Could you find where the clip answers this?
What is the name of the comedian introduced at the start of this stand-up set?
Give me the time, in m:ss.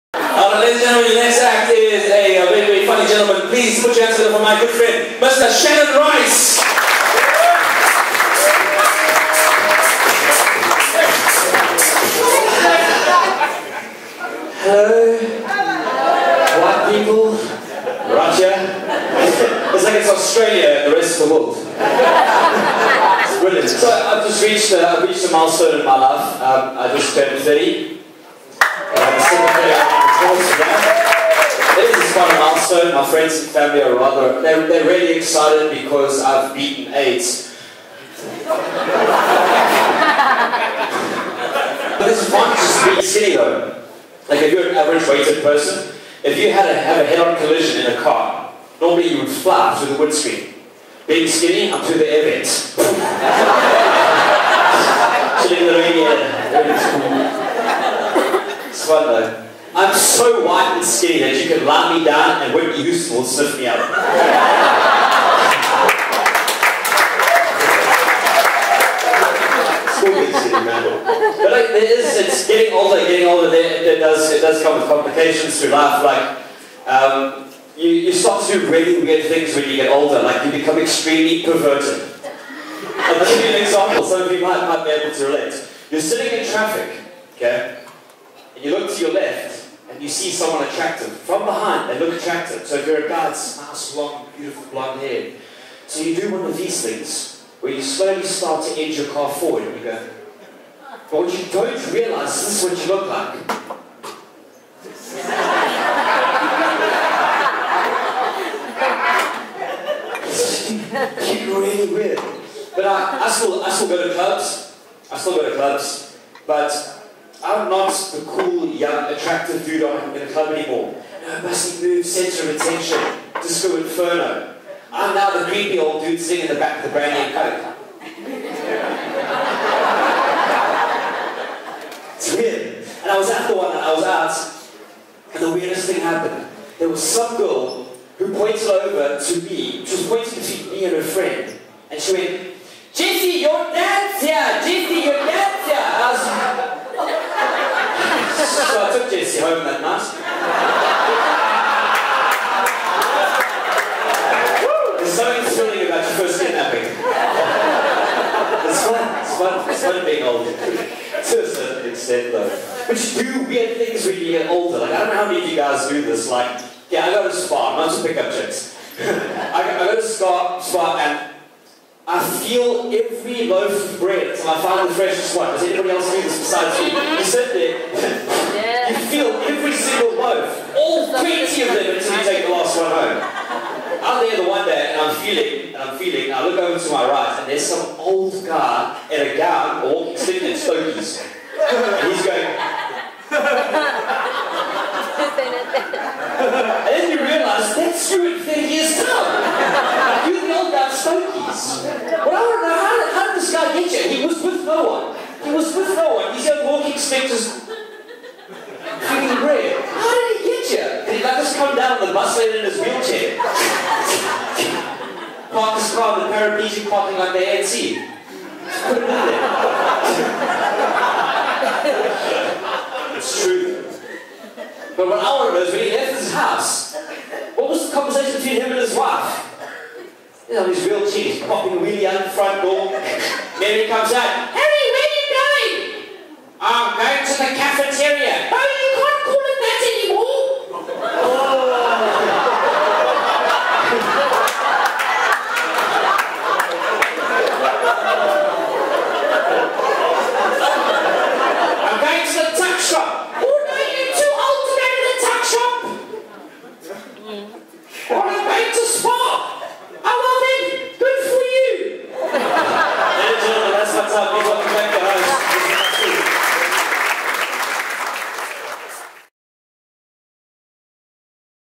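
0:05.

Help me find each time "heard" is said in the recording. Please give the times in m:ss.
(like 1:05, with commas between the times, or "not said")
2:29.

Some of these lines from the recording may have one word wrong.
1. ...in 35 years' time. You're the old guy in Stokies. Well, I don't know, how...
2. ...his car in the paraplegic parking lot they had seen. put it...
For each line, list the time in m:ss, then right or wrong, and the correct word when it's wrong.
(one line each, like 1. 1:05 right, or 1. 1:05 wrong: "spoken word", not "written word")
1. 3:18 wrong: "30", not "35"
2. 3:35 right.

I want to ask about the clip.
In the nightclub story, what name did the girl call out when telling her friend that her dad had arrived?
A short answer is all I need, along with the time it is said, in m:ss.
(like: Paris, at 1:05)
Jesse, at 2:22.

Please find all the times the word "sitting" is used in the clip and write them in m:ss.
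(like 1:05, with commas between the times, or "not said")
1:26, 2:06, 3:10.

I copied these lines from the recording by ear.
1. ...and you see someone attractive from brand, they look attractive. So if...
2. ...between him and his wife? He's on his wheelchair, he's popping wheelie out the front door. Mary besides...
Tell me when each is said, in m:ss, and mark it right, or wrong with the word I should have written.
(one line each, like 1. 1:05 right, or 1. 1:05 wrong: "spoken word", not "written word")
1. 1:29 wrong: "behind", not "brand"
2. 3:48 wrong: "comes", not "besides".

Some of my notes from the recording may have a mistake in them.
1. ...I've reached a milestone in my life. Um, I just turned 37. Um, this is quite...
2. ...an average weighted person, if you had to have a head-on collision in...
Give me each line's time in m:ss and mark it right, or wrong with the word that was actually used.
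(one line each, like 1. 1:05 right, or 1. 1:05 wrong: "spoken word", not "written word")
1. 0:25 wrong: "30", not "37"
2. 0:44 right.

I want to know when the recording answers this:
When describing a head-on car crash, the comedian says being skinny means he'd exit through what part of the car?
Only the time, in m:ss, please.
0:51.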